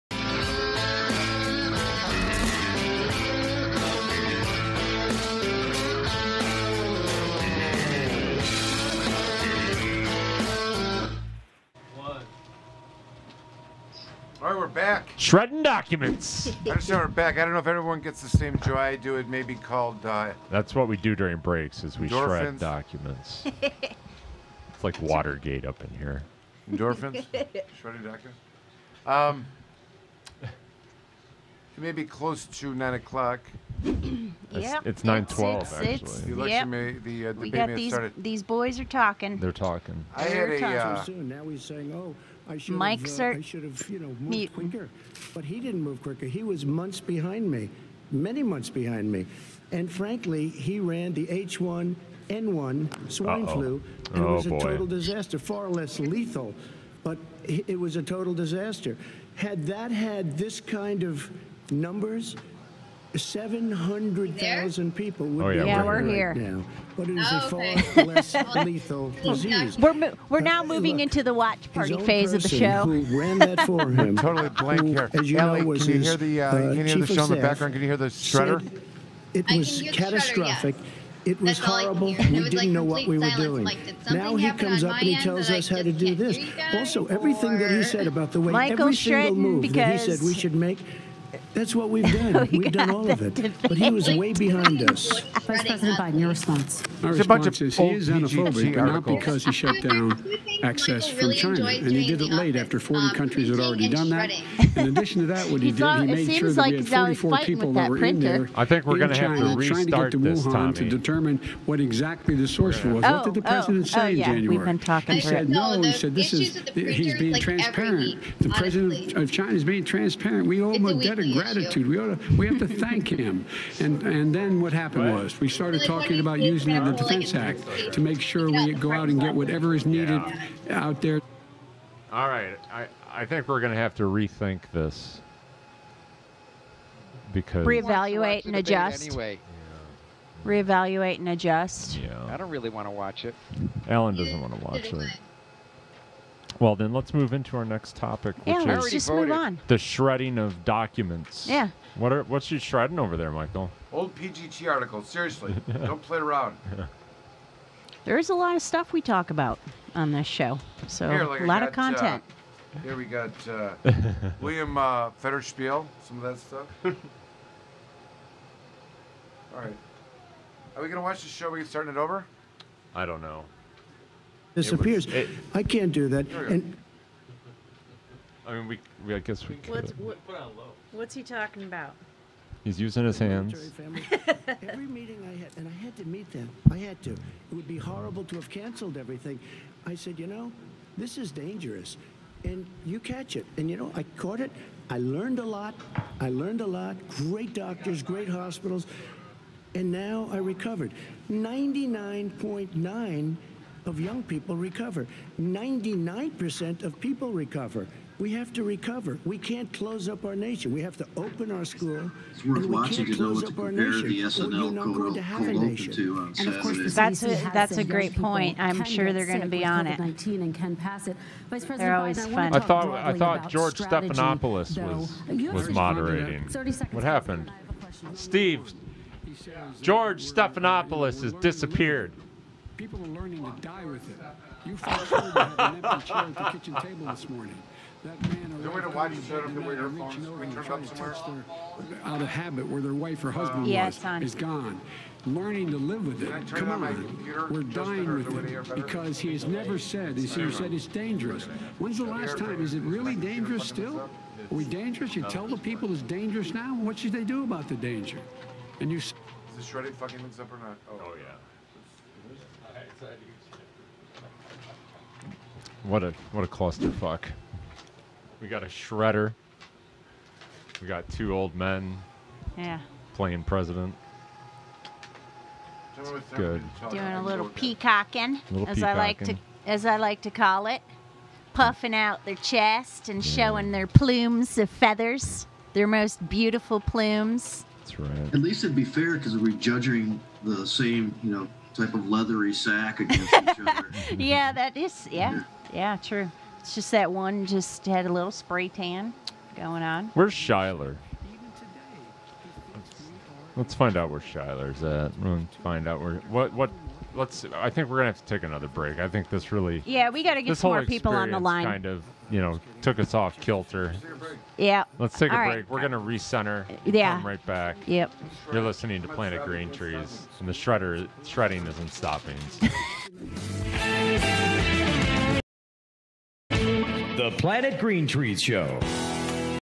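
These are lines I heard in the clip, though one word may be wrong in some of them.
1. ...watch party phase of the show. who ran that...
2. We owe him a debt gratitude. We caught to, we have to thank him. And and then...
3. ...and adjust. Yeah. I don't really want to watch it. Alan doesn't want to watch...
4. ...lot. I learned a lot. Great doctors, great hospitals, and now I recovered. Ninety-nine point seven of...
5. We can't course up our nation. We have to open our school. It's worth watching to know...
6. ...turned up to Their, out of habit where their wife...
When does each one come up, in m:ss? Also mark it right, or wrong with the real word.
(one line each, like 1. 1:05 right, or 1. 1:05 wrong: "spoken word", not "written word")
1. 1:11 right
2. 2:00 wrong: "ought", not "caught"
3. 2:21 right
4. 3:15 wrong: "nine", not "seven"
5. 3:29 wrong: "close", not "course"
6. 4:00 right.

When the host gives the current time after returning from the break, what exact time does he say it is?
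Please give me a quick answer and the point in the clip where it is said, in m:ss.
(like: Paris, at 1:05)
9:12, at 0:35.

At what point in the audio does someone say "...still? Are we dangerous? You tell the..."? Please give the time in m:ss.
4:13.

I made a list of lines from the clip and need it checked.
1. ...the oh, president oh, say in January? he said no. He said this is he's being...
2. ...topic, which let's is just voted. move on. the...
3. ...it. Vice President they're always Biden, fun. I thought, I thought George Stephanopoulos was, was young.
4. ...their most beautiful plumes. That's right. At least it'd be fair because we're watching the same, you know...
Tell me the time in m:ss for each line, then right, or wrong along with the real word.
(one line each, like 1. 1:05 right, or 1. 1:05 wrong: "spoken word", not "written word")
1. 1:53 right
2. 2:27 right
3. 3:41 wrong: "moderating", not "young"
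4. 4:45 wrong: "judging", not "watching".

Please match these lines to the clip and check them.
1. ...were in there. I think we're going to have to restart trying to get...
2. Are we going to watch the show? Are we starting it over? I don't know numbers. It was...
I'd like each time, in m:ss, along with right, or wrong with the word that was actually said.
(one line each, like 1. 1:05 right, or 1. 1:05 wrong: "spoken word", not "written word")
1. 1:47 right
2. 2:50 wrong: "disappears", not "numbers".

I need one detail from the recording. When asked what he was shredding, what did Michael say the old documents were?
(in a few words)
Old PGT articles.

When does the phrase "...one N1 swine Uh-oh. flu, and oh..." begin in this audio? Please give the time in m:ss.
0:51.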